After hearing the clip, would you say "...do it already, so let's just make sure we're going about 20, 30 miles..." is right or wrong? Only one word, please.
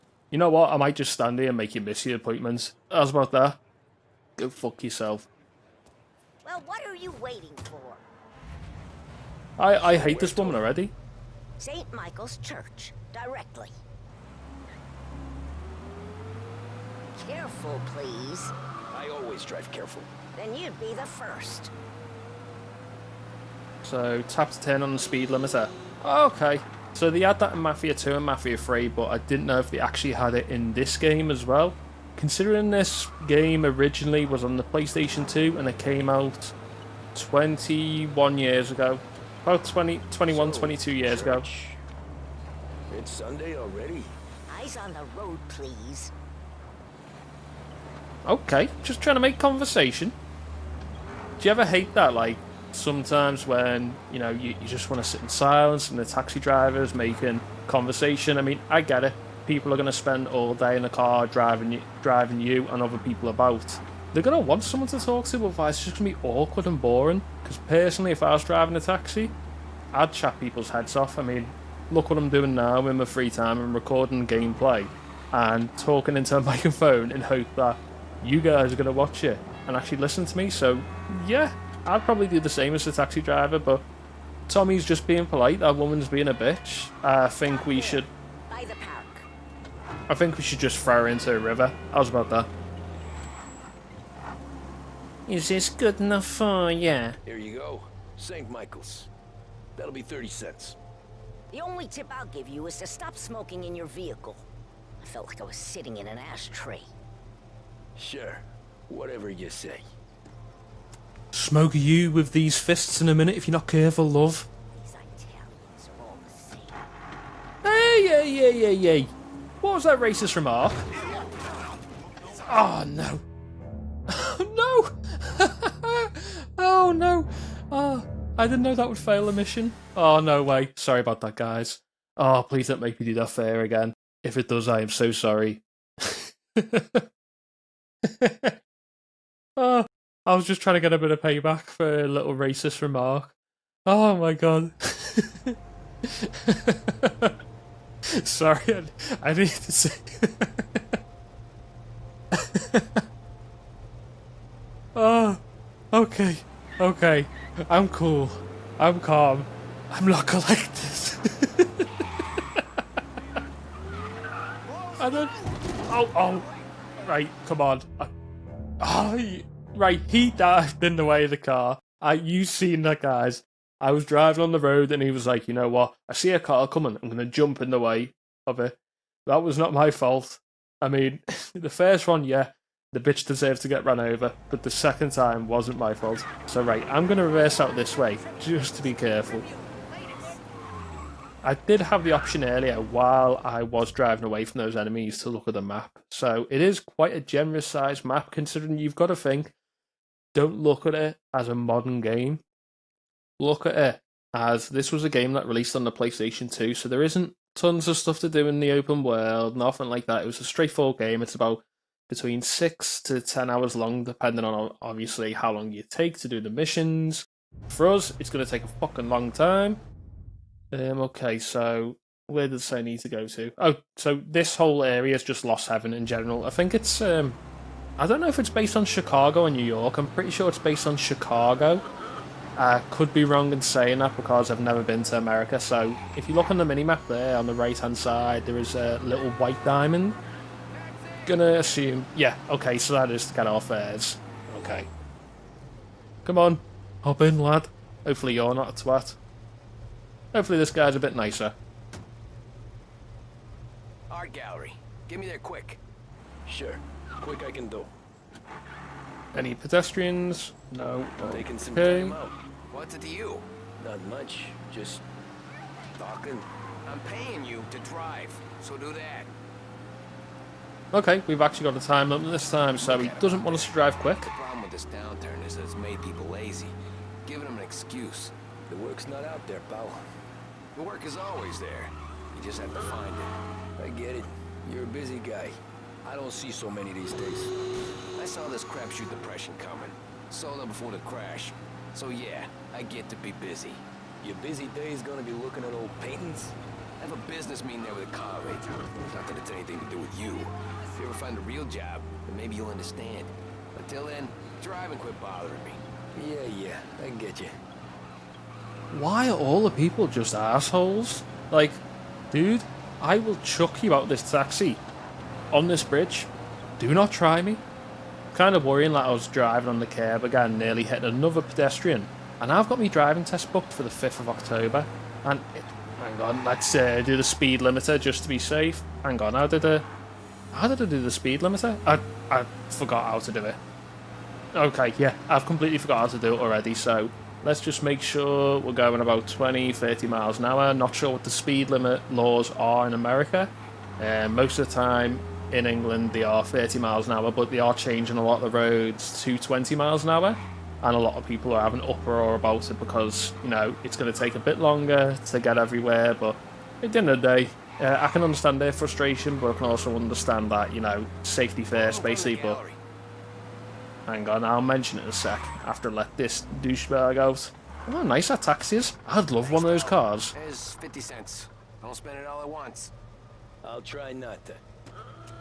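right.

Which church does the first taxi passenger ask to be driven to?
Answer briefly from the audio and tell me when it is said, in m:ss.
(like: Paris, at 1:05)
St. Michael's Church, at 0:11.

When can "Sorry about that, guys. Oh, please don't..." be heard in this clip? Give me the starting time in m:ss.
2:10.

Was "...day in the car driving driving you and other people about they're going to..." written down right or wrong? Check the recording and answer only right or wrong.
right.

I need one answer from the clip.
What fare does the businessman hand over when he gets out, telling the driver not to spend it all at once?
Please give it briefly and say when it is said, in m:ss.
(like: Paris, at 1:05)
50 cents, at 6:10.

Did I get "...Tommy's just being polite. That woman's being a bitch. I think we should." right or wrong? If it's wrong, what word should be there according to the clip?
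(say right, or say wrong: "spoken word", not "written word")
right.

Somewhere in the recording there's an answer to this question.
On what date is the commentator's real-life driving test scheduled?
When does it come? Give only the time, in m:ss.
5:23.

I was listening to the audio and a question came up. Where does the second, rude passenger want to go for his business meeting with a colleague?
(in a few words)
Art gallery.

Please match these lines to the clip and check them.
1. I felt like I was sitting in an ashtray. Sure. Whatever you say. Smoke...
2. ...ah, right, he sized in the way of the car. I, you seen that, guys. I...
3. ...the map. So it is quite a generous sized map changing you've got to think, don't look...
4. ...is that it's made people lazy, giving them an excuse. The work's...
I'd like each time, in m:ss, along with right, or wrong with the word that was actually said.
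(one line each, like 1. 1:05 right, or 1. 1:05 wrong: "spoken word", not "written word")
1. 1:45 right
2. 2:48 wrong: "dived", not "sized"
3. 3:15 wrong: "considering", not "changing"
4. 4:35 right.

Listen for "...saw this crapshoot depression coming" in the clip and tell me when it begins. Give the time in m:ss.
4:48.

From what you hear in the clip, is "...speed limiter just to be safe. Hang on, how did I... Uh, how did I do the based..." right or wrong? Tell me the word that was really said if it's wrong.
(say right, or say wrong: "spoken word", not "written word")
wrong: "speed", not "based".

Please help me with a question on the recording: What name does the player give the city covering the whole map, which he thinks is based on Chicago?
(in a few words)
Lost Heaven.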